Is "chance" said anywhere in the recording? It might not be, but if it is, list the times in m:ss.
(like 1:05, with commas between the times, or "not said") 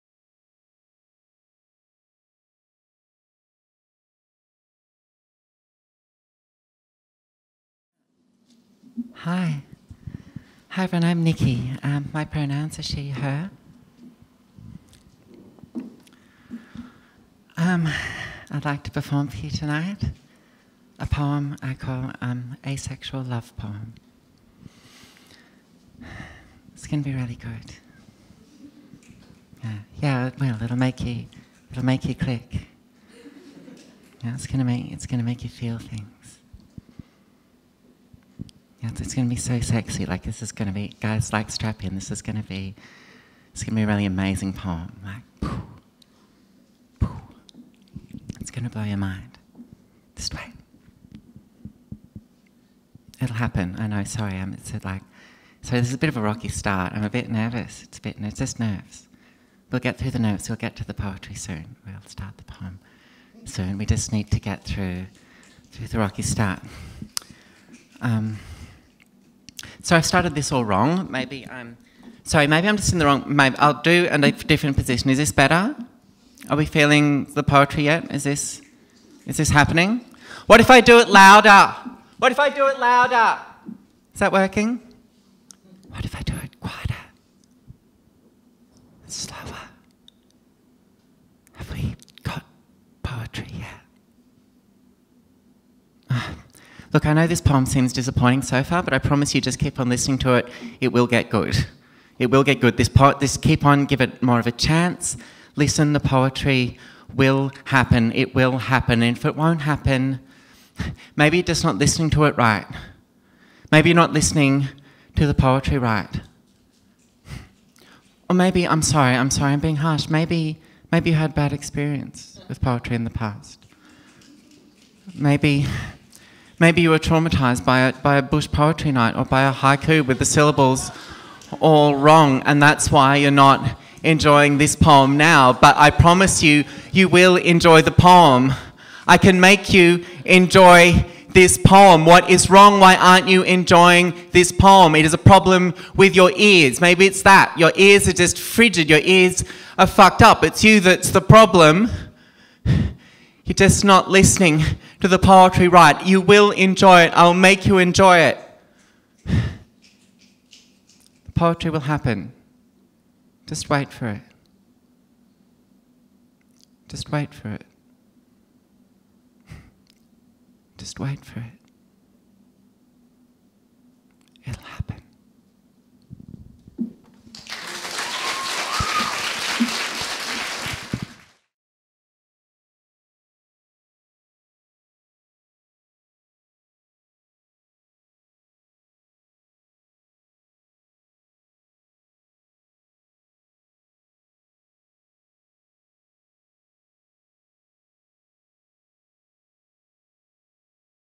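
1:44.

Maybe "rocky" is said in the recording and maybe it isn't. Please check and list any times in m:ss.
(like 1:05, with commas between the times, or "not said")
0:56, 1:05.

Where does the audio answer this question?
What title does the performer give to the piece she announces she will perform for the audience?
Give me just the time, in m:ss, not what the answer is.
0:22.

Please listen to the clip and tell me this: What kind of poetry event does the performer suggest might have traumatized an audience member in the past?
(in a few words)
bush poetry night.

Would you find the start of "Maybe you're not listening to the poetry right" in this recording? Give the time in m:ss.
1:53.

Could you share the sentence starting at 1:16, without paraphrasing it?
Are we feeling the poetry yet?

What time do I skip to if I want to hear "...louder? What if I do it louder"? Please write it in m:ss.
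1:21.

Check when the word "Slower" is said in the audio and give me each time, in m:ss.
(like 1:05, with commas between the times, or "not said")
1:29.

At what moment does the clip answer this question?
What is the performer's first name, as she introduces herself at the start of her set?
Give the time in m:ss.
0:11.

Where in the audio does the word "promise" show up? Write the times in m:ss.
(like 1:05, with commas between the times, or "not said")
1:38, 2:15.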